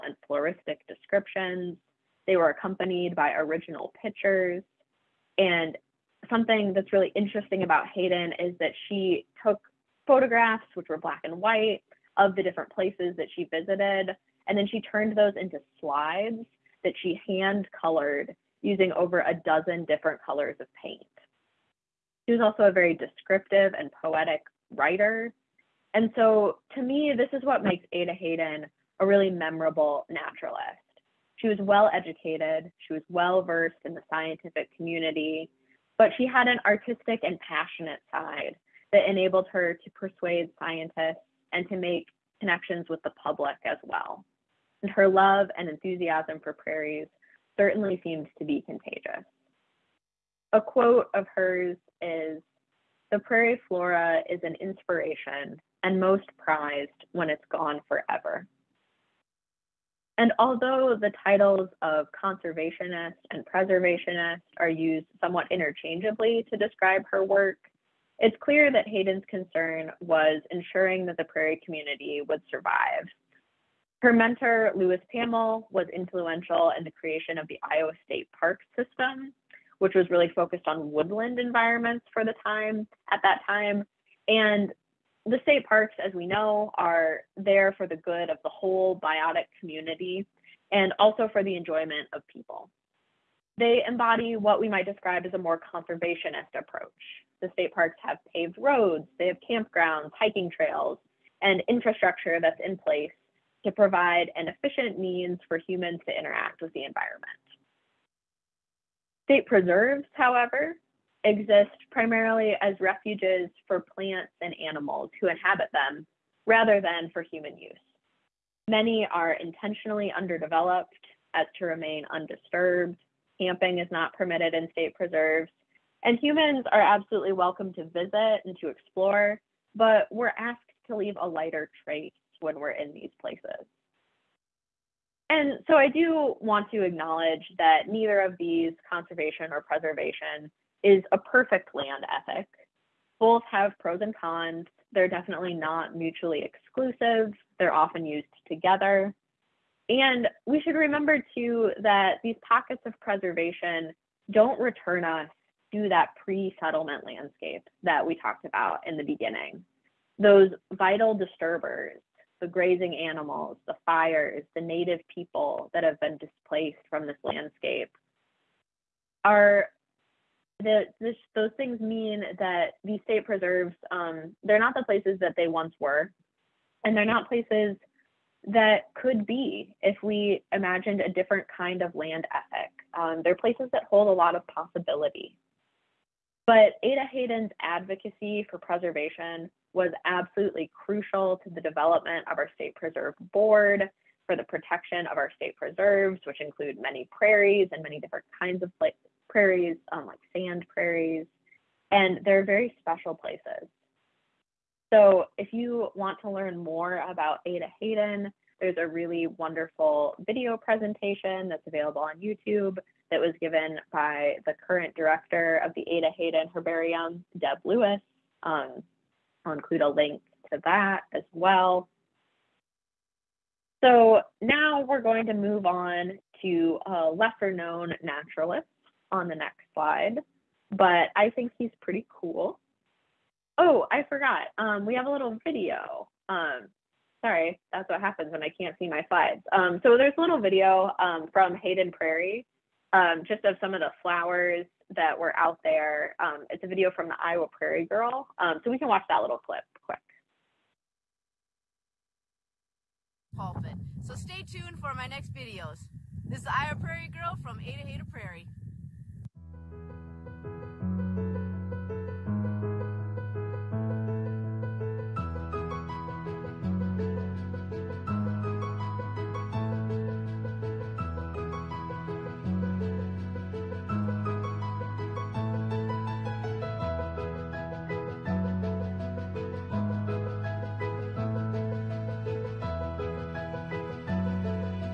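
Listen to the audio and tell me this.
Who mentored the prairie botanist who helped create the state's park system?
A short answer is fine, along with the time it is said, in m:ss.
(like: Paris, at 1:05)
Louis Pammel, at 1:14.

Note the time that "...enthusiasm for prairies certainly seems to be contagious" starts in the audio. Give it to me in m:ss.
0:45.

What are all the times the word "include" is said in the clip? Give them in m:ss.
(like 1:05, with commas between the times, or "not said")
3:16, 3:39.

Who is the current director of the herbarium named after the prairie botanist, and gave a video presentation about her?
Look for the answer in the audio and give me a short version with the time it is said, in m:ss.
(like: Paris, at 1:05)
Deb Lewis, at 3:37.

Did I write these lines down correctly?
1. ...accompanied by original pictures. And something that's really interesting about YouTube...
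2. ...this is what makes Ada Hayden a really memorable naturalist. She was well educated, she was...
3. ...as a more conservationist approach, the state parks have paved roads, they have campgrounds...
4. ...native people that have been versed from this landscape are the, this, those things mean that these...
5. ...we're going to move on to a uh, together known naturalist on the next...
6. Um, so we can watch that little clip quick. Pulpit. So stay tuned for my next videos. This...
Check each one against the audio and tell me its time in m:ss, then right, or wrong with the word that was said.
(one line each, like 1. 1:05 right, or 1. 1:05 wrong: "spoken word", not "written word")
1. 0:02 wrong: "Hayden", not "YouTube"
2. 0:27 right
3. 1:35 right
4. 2:44 wrong: "displaced", not "versed"
5. 3:44 wrong: "lesser", not "together"
6. 4:08 right.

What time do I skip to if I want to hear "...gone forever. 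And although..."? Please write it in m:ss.
0:57.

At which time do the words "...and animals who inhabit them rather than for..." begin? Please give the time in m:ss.
1:54.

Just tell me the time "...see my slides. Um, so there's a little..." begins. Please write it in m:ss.
3:58.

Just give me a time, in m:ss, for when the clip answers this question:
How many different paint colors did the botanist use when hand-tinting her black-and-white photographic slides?
0:18.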